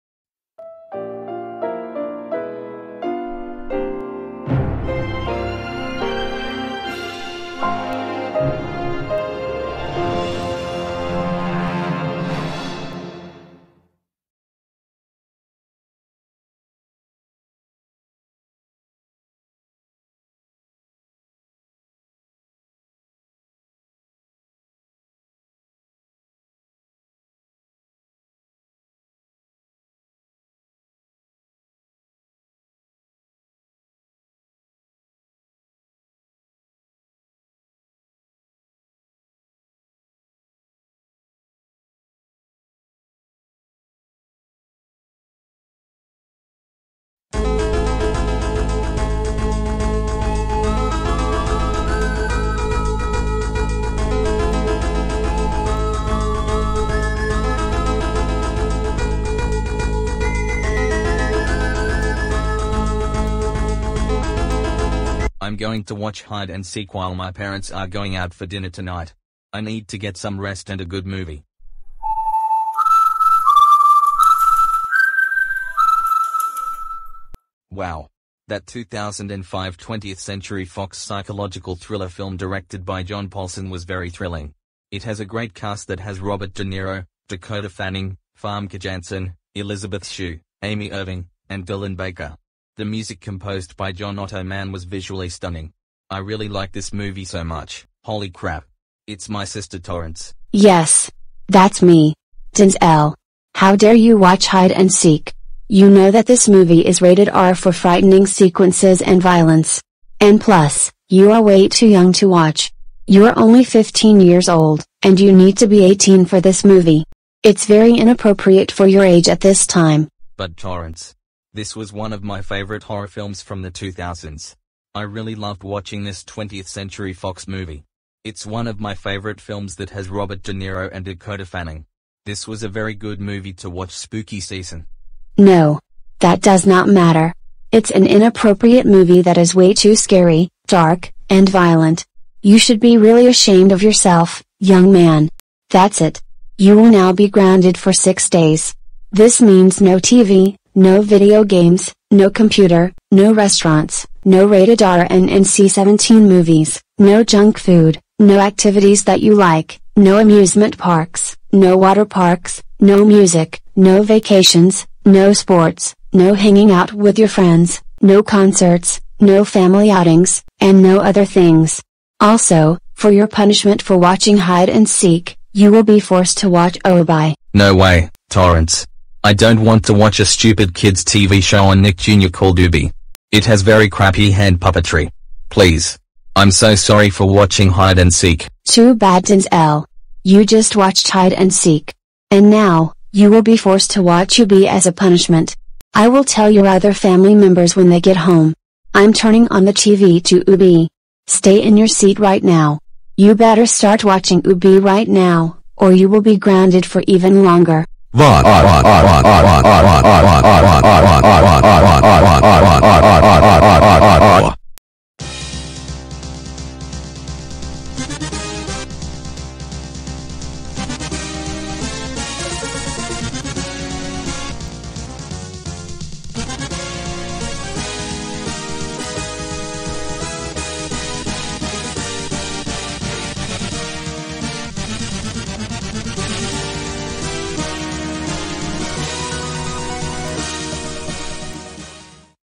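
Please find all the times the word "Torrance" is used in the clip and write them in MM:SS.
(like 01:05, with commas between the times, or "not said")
01:39, 02:00, 02:58.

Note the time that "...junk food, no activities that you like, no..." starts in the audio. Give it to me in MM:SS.
02:37.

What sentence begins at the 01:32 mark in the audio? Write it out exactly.
The music composed by John Ottman was visually stunning.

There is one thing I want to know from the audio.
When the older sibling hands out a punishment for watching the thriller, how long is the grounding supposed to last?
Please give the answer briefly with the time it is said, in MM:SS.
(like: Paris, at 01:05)
6 days, at 02:27.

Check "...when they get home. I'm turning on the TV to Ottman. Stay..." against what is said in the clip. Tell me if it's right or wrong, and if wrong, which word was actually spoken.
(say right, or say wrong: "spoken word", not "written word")
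wrong: "Oobi", not "Ottman".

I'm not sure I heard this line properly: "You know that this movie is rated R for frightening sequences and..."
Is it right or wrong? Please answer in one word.
right.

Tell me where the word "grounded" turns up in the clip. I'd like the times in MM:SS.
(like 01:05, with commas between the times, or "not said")
02:27, 03:26.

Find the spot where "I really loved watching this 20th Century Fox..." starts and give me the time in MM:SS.
02:04.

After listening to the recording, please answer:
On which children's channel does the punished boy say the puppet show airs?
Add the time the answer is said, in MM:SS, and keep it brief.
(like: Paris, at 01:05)
Nick Jr., at 03:01.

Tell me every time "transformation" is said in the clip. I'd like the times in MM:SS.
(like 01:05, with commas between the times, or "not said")
not said.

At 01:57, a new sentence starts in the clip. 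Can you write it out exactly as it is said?
It's very inappropriate for your age at this time.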